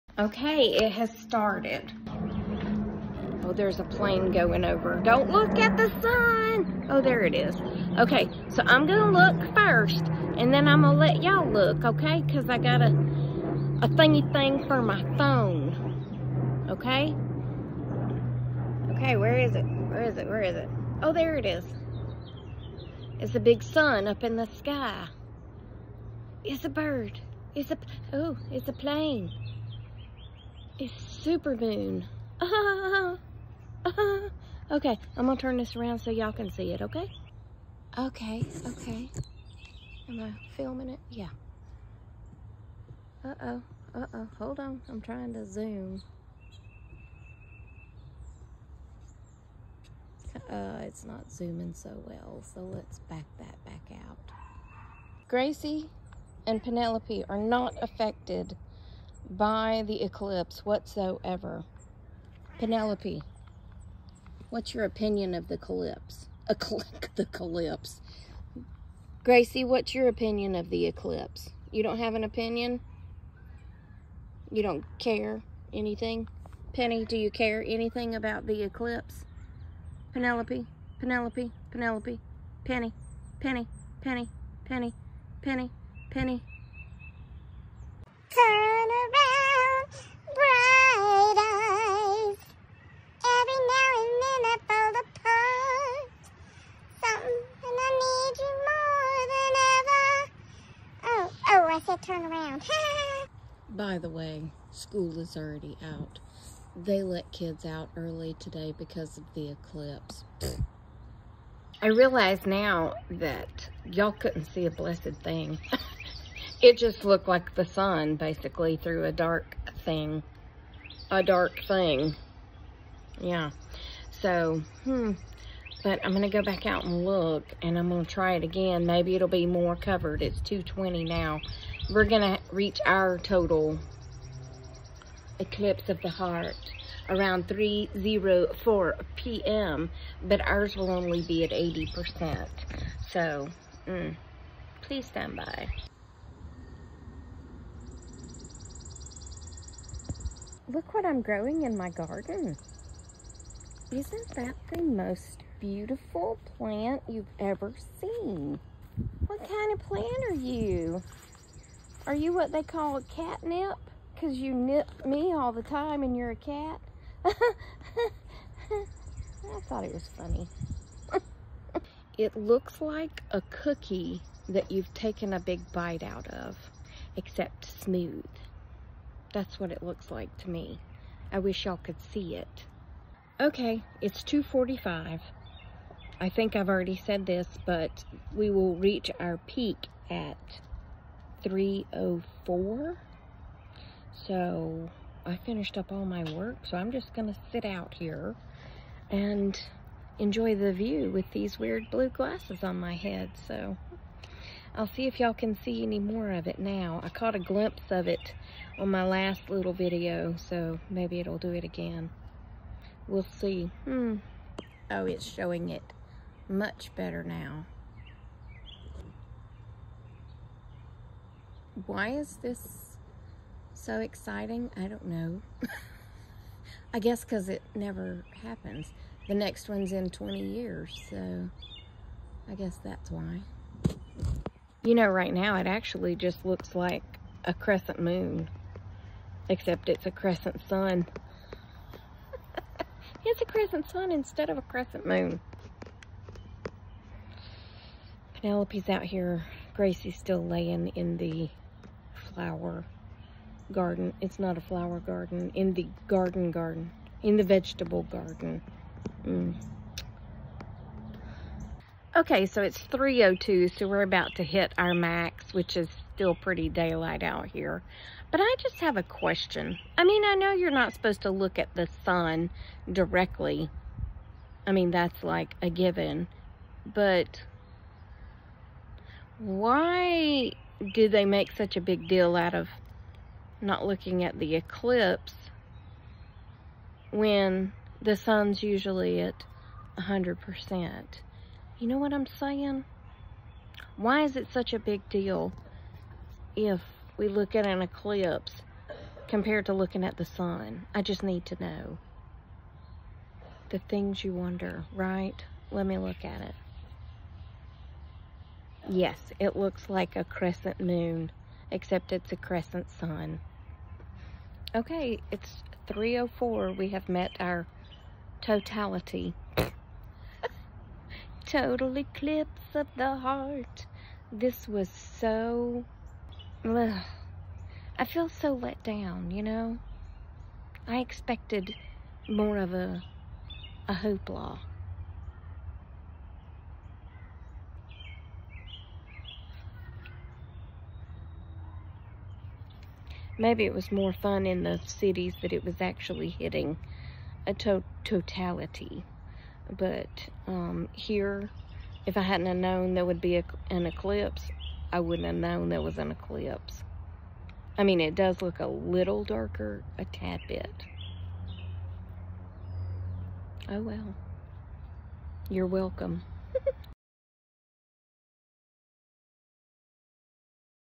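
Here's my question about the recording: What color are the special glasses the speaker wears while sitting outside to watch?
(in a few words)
blue.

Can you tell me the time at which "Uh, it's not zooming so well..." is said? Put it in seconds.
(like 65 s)
50 s.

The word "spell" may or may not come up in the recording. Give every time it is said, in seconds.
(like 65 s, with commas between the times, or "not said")
not said.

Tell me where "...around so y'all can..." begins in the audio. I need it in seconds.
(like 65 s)
35 s.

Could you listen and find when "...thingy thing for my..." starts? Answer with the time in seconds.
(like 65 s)
13 s.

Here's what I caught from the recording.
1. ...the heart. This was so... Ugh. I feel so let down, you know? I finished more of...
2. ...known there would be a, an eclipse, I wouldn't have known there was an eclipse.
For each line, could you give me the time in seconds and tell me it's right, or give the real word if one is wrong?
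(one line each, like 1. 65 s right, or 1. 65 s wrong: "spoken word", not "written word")
1. 322 s wrong: "expected", not "finished"
2. 352 s right.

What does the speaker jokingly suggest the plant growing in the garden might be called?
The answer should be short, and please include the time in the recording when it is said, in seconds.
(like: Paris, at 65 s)
catnip, at 163 s.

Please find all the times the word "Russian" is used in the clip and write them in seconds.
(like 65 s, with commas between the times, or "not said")
not said.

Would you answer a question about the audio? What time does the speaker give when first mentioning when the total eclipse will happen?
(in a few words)
2:20.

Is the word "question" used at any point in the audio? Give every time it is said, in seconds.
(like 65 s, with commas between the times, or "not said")
269 s.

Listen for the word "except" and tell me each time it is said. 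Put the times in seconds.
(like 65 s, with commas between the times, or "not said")
177 s, 239 s, 311 s.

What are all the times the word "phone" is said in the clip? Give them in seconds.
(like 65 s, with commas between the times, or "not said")
15 s.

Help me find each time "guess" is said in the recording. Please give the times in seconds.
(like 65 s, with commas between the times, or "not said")
226 s, 232 s.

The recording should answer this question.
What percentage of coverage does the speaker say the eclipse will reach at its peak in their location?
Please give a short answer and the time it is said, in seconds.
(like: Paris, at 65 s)
80%, at 141 s.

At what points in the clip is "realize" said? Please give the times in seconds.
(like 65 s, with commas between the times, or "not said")
111 s.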